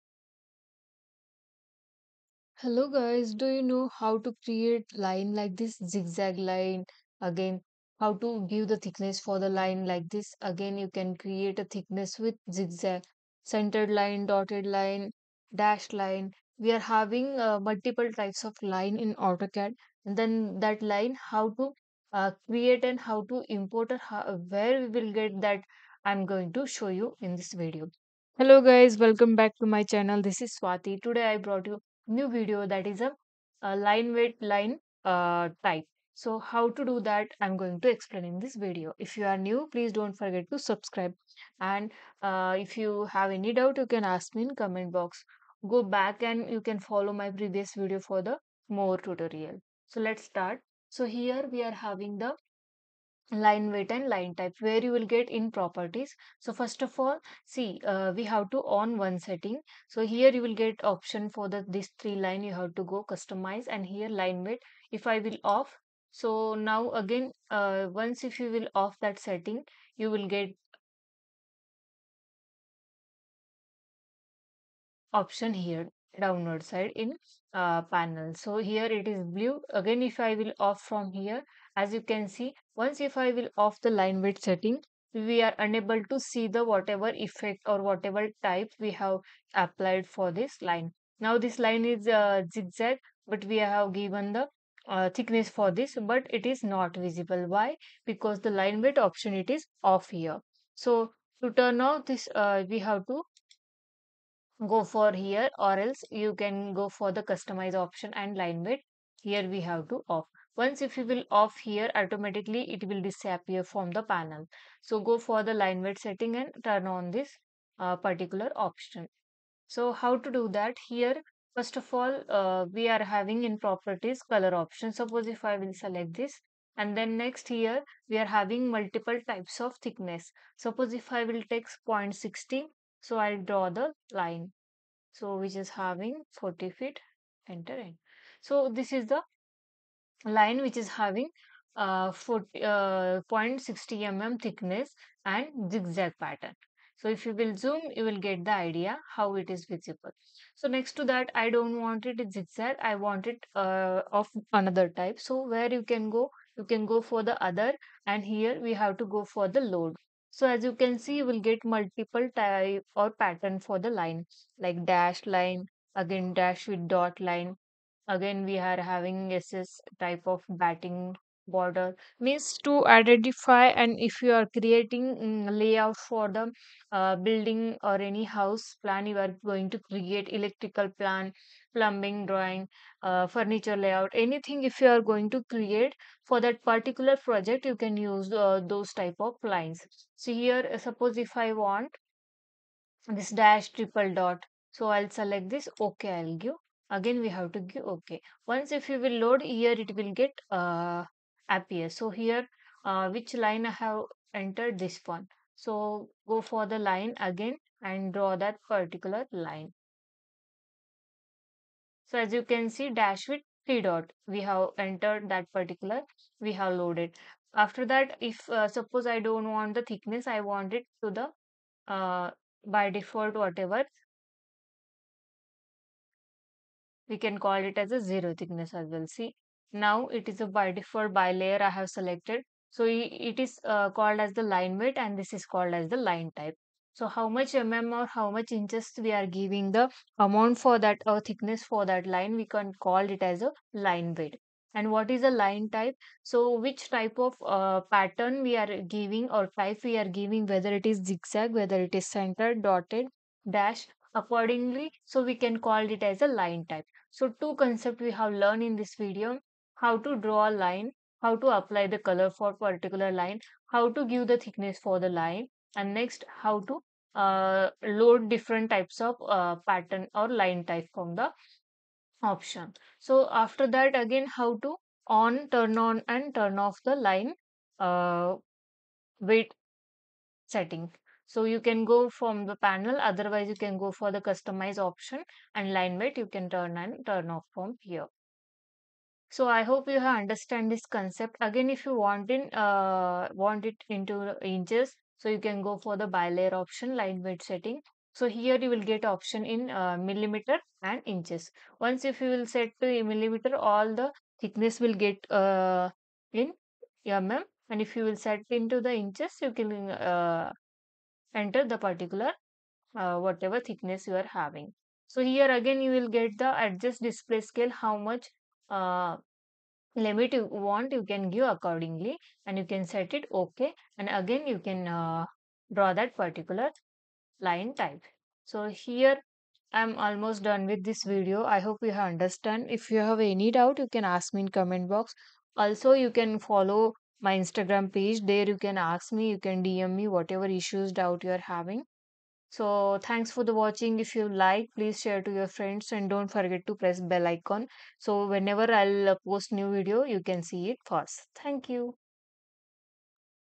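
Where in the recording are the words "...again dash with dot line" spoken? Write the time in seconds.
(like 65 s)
165 s.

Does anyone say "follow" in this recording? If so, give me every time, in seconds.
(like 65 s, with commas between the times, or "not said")
46 s, 336 s.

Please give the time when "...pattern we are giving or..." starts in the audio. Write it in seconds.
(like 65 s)
247 s.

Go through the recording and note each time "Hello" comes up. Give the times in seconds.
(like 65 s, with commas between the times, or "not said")
2 s, 28 s.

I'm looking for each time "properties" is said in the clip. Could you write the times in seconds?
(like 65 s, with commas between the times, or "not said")
55 s, 123 s.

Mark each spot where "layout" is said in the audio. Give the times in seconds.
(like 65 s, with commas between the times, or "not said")
175 s, 183 s.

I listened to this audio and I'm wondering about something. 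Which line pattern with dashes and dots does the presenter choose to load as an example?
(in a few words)
Dash triple dot.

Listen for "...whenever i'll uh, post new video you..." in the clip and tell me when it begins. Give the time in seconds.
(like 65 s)
348 s.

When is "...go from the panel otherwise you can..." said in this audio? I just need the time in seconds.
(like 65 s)
281 s.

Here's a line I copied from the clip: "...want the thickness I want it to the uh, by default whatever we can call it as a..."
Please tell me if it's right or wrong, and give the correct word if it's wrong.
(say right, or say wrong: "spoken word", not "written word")
right.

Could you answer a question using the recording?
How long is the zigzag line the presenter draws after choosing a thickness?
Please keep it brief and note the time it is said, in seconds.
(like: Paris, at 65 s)
40 feet, at 136 s.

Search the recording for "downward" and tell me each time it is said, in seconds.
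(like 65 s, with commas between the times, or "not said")
76 s.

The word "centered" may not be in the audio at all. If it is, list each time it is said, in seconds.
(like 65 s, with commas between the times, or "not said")
13 s, 252 s.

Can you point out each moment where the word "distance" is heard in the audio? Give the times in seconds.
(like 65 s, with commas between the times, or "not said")
not said.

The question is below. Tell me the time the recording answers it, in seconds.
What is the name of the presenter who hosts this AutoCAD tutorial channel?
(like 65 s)
30 s.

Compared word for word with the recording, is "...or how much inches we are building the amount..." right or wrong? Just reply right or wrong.
wrong.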